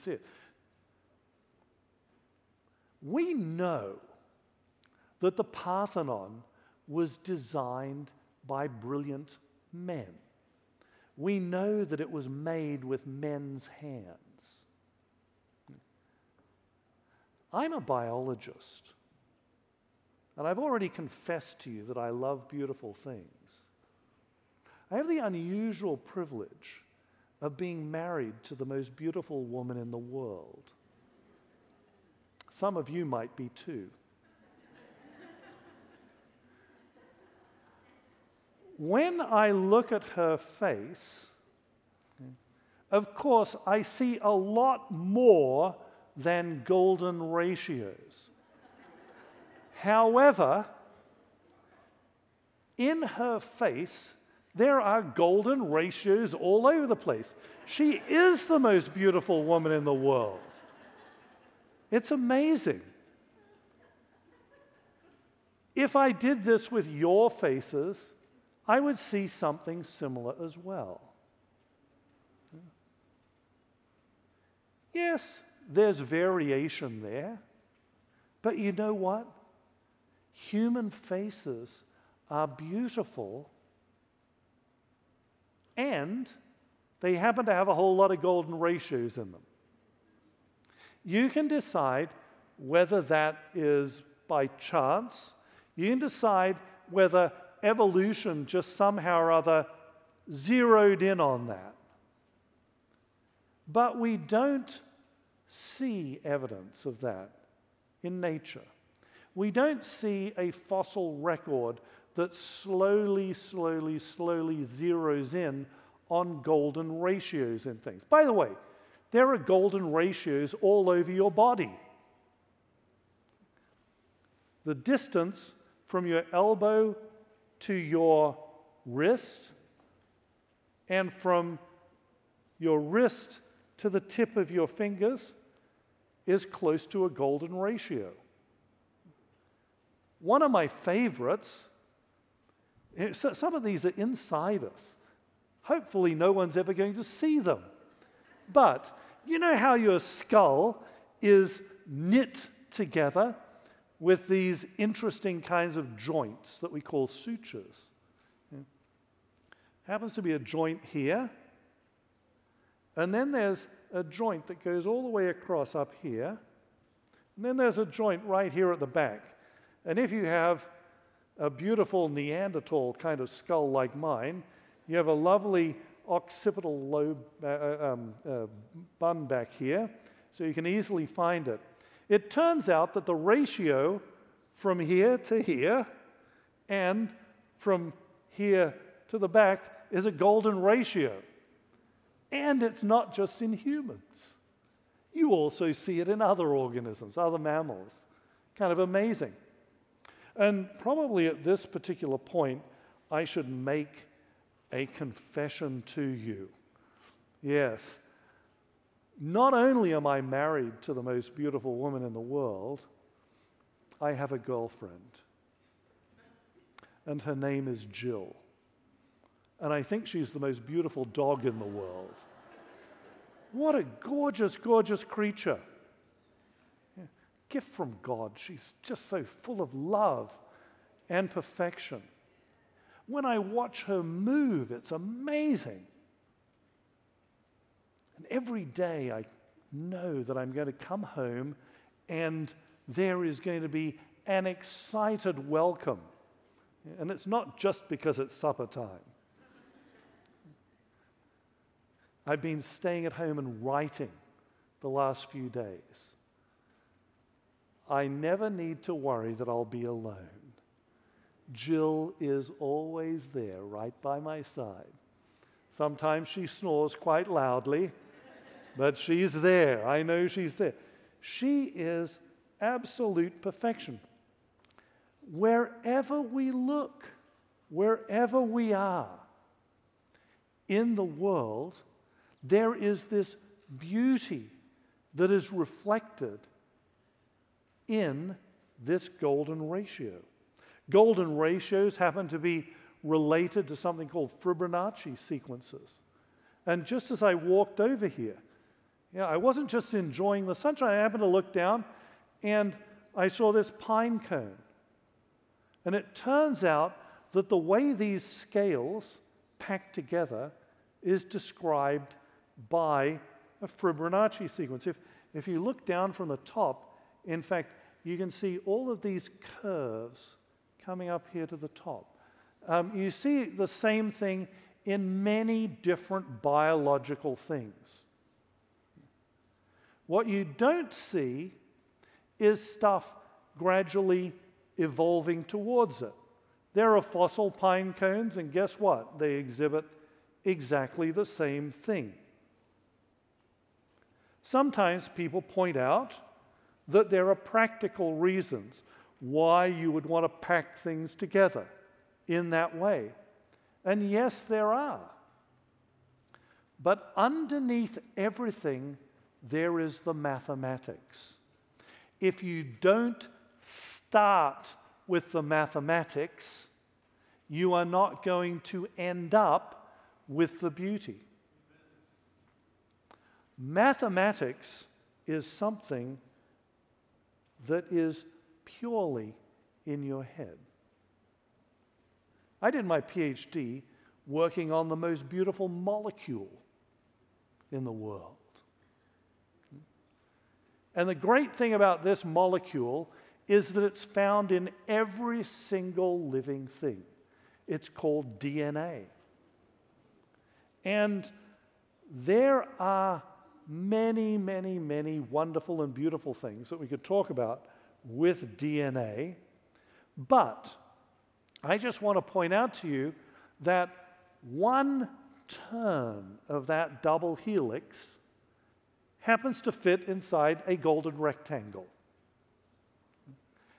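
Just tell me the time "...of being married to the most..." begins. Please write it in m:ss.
0:27.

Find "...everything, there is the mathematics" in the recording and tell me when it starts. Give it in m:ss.
5:58.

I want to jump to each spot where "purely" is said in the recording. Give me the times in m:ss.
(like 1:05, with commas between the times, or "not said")
6:18.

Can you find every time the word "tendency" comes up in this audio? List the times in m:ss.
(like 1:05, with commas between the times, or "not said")
not said.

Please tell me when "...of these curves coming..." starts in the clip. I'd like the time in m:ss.
5:18.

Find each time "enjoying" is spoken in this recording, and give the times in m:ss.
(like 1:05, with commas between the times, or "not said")
4:59.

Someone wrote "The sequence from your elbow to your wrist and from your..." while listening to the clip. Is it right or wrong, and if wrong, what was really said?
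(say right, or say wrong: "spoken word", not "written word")
wrong: "distance", not "sequence".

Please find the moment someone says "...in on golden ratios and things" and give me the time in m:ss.
1:55.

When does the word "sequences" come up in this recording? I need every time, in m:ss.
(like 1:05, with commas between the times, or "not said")
4:55, 5:14.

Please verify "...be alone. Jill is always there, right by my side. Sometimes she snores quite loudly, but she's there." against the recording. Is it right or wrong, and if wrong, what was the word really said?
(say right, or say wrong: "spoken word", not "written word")
right.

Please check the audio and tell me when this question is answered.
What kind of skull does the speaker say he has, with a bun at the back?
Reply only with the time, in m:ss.
2:52.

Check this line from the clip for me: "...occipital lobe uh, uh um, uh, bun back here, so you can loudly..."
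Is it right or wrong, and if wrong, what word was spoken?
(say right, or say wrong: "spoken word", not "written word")
wrong: "easily", not "loudly".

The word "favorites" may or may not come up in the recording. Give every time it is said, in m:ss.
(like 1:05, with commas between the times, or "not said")
2:20.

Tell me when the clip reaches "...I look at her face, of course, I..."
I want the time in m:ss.
0:39.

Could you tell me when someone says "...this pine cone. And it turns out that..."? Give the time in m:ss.
5:03.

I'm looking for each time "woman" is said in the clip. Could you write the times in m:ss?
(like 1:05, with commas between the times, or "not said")
0:29, 0:59, 3:31.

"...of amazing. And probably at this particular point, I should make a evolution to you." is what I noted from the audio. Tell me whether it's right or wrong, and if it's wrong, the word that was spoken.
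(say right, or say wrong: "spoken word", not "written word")
wrong: "confession", not "evolution".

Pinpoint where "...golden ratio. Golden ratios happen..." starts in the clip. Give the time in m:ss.
4:49.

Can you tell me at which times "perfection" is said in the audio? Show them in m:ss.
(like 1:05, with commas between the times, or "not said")
3:51, 4:33.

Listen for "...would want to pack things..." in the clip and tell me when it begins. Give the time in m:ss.
5:49.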